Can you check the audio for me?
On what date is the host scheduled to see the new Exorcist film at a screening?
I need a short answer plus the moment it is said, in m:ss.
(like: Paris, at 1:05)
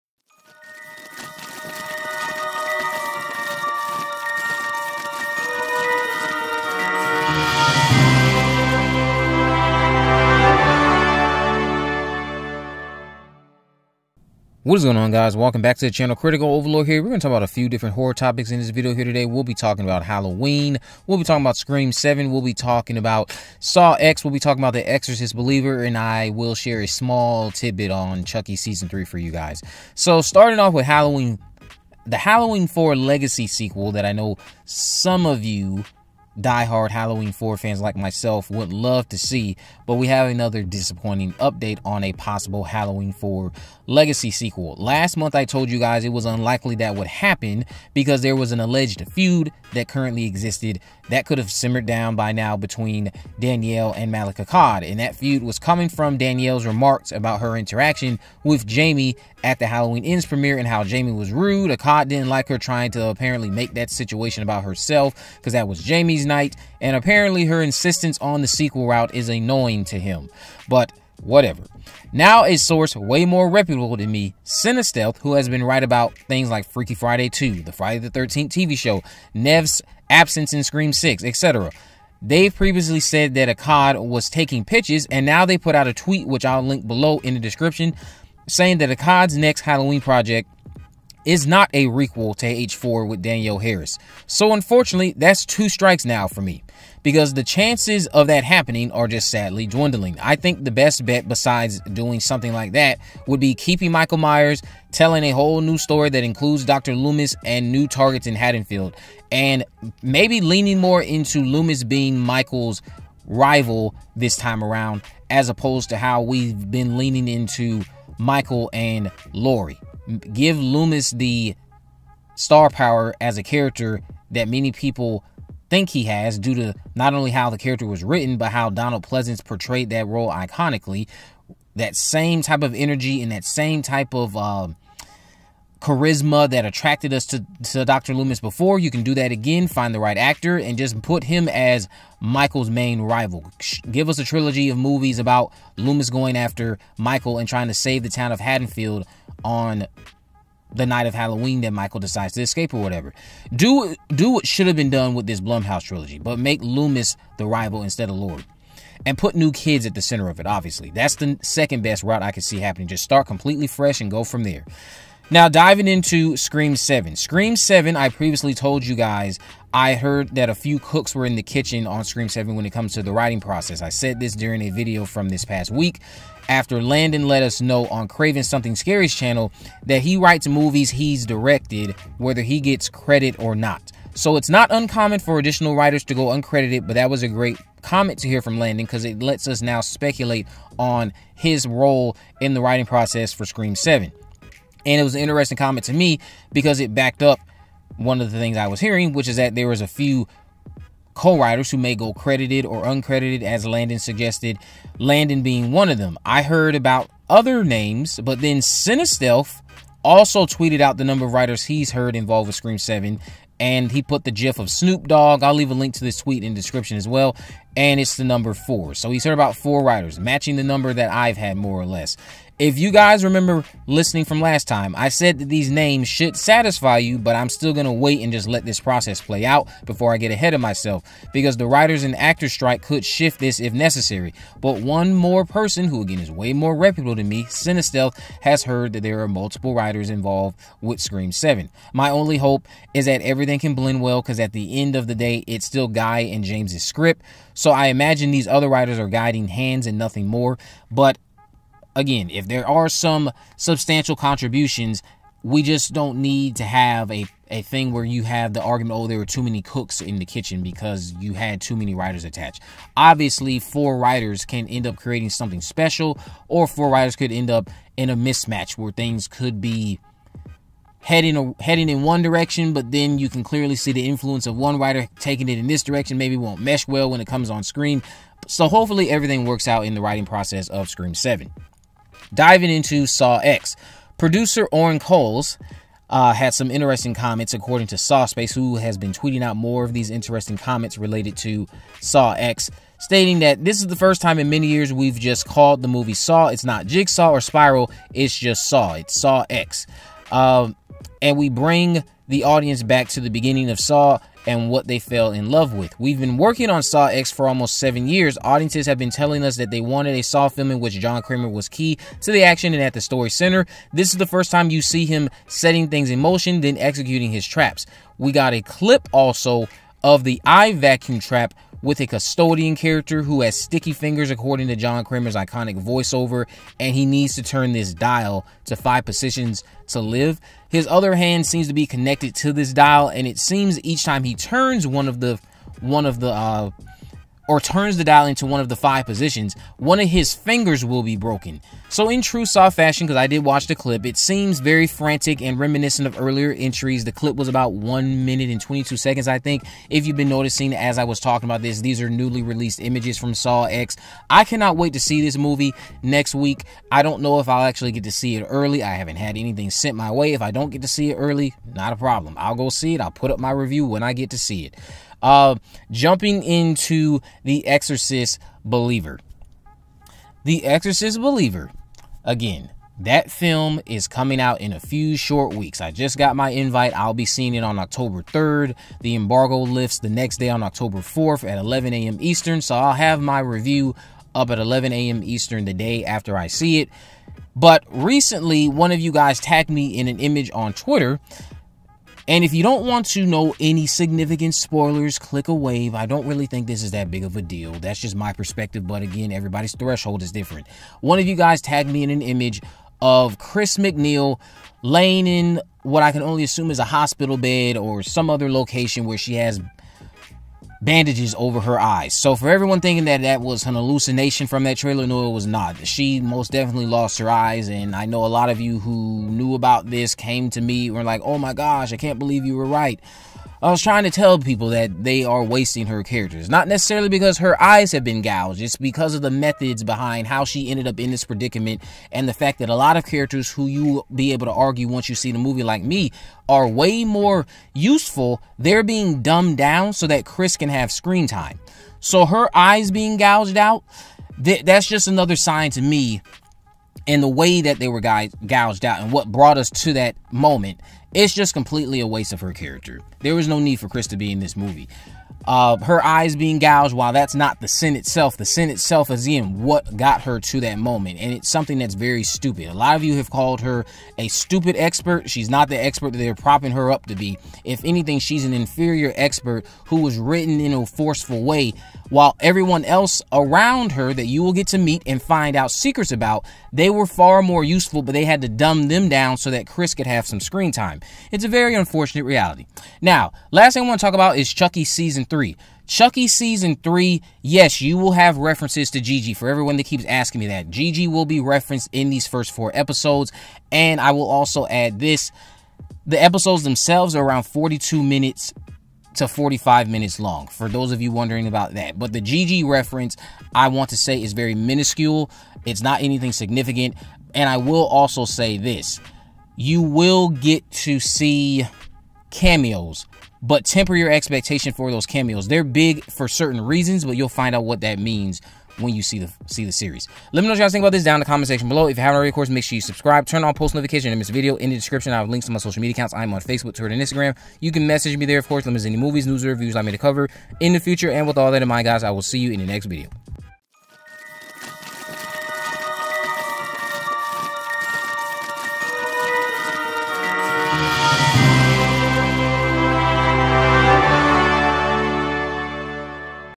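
October 3rd, at 6:17.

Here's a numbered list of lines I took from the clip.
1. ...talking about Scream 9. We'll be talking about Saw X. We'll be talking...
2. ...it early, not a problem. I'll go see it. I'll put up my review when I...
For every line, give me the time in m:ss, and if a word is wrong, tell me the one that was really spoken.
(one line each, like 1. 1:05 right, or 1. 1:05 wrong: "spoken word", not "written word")
1. 0:21 wrong: "7", not "9"
2. 6:01 right.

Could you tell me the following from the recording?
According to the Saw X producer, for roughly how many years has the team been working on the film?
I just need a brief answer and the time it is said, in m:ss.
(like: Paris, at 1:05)
7, at 5:07.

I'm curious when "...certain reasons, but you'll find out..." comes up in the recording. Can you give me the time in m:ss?
8:36.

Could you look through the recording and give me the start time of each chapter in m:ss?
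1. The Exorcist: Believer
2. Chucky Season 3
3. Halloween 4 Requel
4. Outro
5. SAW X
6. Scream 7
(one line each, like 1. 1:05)
1. 6:07
2. 8:03
3. 0:14
4. 8:53
5. 4:41
6. 2:45.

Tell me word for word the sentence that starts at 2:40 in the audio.
That's the second best route I could see happening.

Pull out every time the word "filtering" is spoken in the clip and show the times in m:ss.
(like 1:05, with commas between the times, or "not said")
not said.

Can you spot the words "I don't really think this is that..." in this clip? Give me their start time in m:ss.
6:35.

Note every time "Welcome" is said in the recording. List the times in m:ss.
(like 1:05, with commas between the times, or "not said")
0:15.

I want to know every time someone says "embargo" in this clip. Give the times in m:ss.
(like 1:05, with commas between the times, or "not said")
6:19.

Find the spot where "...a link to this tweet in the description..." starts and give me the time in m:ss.
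3:35.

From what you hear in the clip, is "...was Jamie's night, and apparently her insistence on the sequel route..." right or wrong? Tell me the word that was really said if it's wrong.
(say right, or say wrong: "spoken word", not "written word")
right.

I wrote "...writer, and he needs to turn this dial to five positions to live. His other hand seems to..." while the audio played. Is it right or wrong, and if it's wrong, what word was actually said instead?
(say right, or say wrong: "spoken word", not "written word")
wrong: "voiceover", not "writer".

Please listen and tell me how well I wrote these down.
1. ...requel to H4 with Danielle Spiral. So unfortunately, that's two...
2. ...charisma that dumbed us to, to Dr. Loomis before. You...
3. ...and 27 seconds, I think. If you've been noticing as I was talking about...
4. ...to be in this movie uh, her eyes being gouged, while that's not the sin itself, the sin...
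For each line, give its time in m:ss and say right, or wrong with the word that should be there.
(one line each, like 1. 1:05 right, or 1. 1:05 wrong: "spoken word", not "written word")
1. 1:31 wrong: "Harris", not "Spiral"
2. 2:15 wrong: "attracted", not "dumbed"
3. 5:48 wrong: "22", not "27"
4. 7:34 right.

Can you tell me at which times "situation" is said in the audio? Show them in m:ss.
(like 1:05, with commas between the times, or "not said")
1:03.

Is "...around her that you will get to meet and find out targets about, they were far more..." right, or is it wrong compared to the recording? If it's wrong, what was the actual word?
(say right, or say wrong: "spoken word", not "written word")
wrong: "secrets", not "targets".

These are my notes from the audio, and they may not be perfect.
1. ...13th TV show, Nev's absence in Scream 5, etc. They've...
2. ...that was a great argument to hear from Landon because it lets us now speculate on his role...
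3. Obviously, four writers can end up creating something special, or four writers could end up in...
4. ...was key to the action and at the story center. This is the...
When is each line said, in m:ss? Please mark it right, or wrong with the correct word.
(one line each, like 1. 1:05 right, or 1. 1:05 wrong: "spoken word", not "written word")
1. 1:18 wrong: "6", not "5"
2. 3:06 wrong: "comment", not "argument"
3. 4:22 right
4. 5:11 right.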